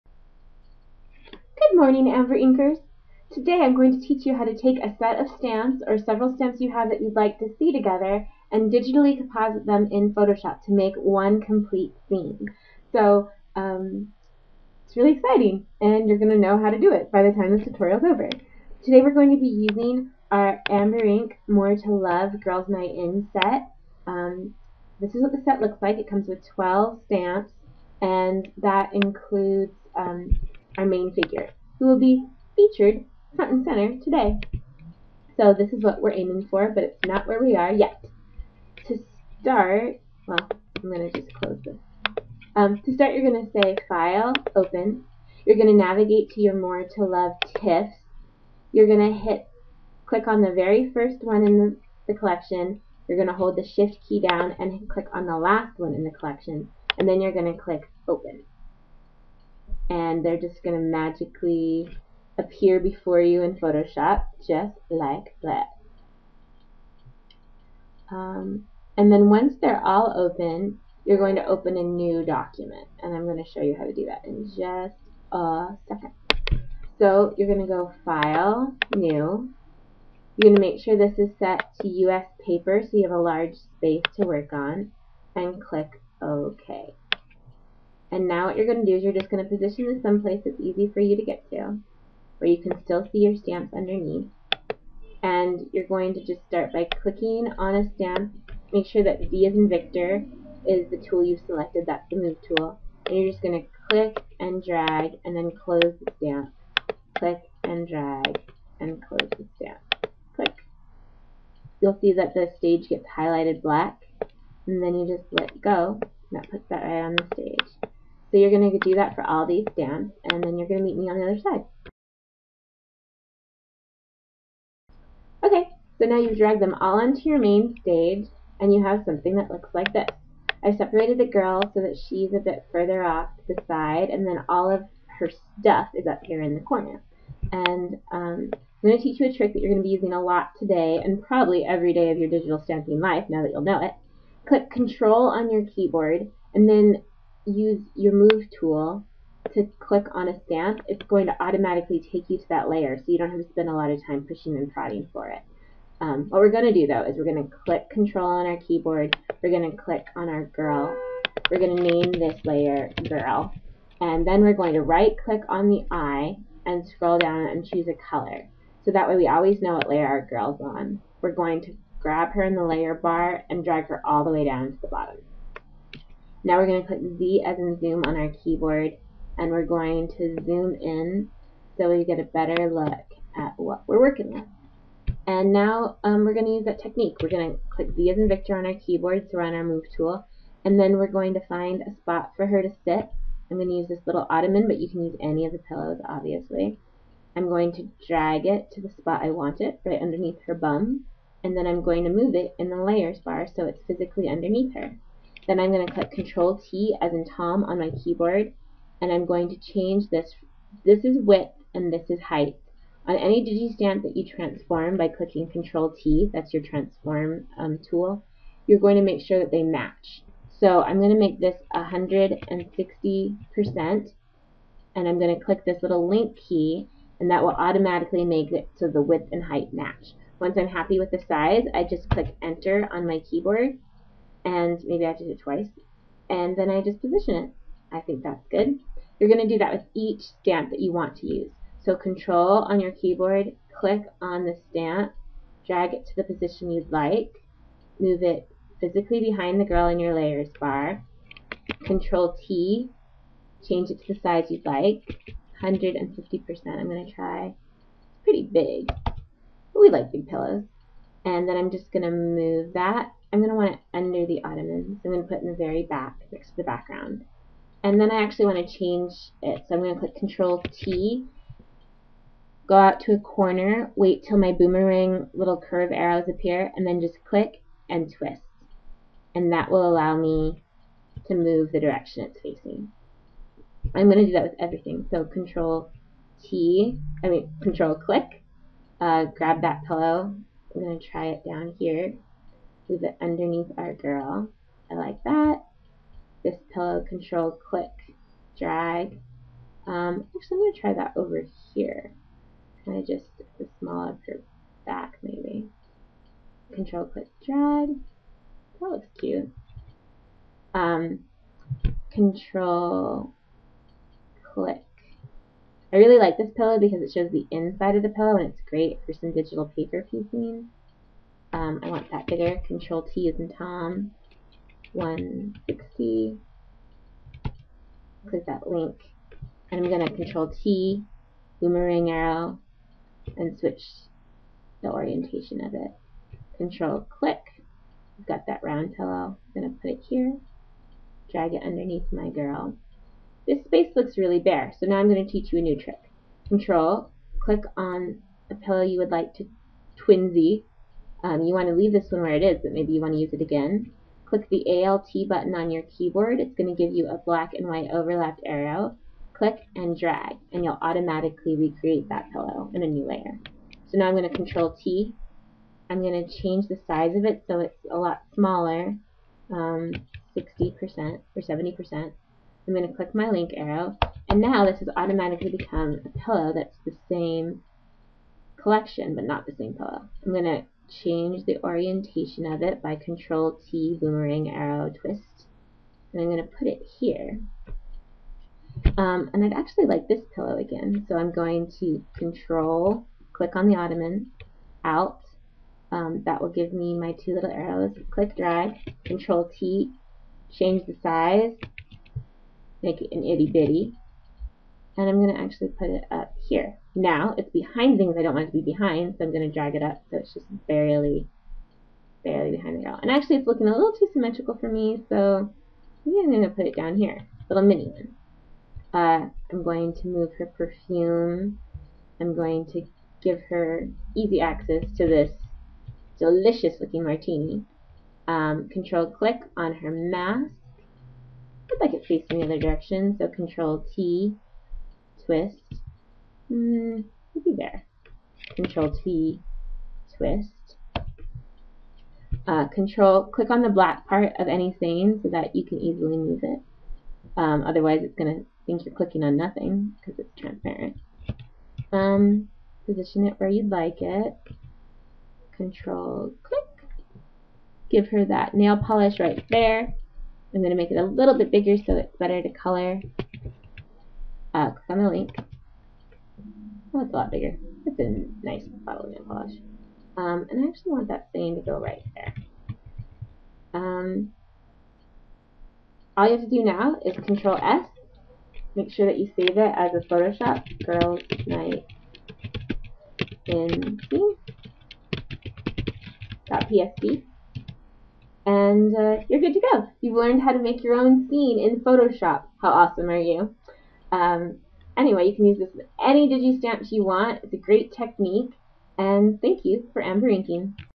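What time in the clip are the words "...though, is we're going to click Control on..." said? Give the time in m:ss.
2:36.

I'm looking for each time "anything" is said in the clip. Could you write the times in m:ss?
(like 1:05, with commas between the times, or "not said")
7:24.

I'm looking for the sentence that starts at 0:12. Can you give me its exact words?
So um, it's really exciting and you're going to know how to do it by the time this tutorial is over.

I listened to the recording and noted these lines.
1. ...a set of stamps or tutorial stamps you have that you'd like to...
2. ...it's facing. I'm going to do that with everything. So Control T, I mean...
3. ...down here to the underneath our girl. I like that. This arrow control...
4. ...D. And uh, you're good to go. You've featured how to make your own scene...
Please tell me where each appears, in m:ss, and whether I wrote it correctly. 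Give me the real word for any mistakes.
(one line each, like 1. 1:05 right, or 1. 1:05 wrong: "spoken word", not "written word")
1. 0:04 wrong: "several", not "tutorial"
2. 4:42 right
3. 4:51 wrong: "pillow", not "arrow"
4. 8:06 wrong: "learned", not "featured".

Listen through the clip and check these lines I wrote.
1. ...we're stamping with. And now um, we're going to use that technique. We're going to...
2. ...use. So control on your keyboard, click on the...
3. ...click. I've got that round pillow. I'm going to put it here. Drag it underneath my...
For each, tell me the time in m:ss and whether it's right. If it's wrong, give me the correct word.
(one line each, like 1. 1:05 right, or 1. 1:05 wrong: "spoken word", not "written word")
1. 3:03 wrong: "working", not "stamping"
2. 4:01 right
3. 5:37 right.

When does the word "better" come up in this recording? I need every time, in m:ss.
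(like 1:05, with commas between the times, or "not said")
3:02, 7:42.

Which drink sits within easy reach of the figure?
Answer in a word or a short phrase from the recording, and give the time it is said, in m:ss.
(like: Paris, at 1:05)
martini, at 7:07.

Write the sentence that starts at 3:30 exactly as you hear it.
This is width and this is height.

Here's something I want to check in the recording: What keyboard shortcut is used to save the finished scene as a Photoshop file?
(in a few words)
Control S.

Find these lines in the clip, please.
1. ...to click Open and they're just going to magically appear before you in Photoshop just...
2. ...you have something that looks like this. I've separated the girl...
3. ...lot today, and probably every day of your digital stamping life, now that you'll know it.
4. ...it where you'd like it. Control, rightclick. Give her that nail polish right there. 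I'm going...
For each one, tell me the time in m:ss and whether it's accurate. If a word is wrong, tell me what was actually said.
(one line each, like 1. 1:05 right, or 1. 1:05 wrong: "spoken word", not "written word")
1. 0:57 right
2. 2:08 right
3. 2:20 right
4. 7:33 wrong: "click", not "rightclick".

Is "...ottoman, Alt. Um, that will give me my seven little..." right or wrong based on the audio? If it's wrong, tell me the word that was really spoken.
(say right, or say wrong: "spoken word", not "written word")
wrong: "two", not "seven".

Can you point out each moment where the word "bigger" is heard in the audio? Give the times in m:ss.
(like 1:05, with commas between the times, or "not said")
5:22, 7:41, 7:47.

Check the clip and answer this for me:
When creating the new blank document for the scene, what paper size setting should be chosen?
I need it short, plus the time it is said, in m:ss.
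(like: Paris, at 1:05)
US paper, at 1:21.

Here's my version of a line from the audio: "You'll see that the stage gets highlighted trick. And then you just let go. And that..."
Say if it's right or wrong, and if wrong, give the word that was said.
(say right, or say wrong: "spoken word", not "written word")
wrong: "black", not "trick".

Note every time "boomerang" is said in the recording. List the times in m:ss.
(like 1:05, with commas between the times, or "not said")
4:34, 5:31, 6:24.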